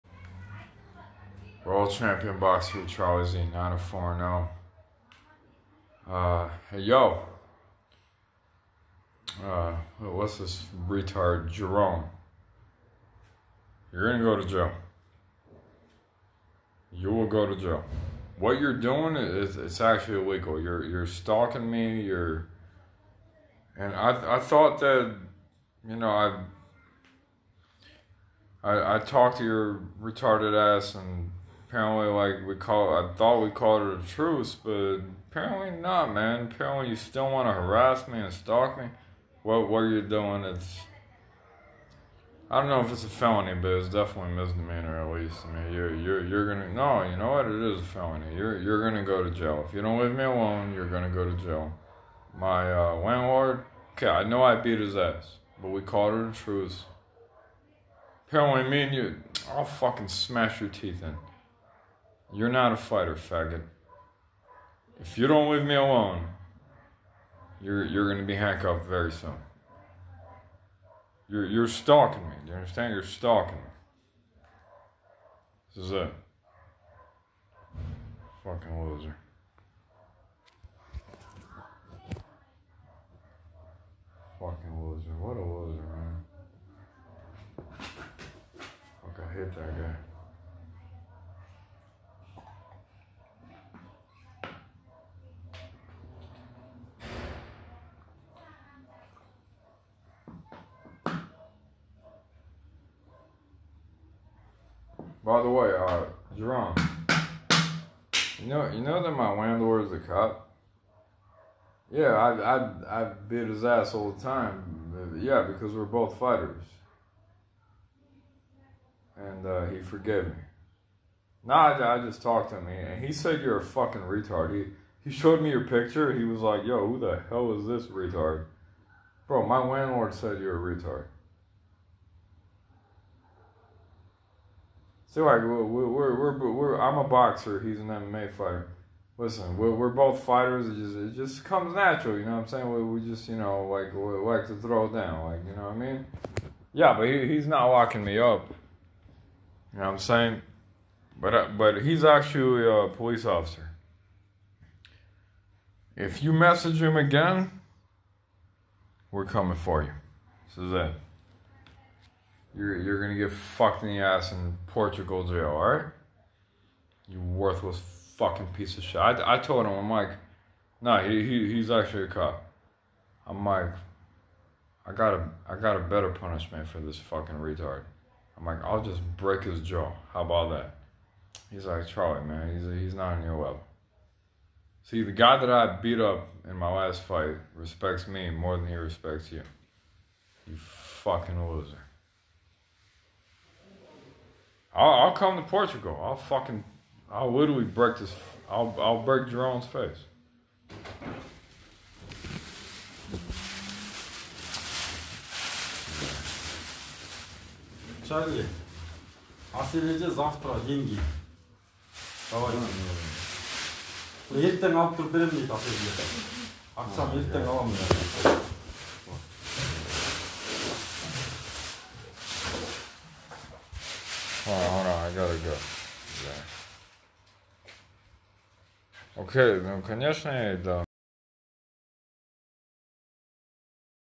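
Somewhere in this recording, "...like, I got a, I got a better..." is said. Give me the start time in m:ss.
2:53.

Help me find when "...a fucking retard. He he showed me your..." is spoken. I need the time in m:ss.
2:03.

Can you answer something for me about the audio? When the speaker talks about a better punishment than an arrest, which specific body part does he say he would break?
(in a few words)
His jaw.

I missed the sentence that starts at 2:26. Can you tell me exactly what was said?
Yeah, but he, he's not locking me up.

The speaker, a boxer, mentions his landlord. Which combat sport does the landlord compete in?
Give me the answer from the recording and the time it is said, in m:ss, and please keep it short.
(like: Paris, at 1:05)
MMA, at 2:17.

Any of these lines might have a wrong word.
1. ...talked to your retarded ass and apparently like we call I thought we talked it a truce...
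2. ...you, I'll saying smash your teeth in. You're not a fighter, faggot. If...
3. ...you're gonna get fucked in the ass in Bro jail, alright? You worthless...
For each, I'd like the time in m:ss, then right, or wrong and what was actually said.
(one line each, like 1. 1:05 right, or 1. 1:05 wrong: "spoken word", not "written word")
1. 0:28 wrong: "called", not "talked"
2. 0:58 wrong: "fucking", not "saying"
3. 2:42 wrong: "Portugal", not "Bro".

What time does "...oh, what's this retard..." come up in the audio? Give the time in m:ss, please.
0:09.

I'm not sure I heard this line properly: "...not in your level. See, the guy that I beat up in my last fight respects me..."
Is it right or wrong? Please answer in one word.
right.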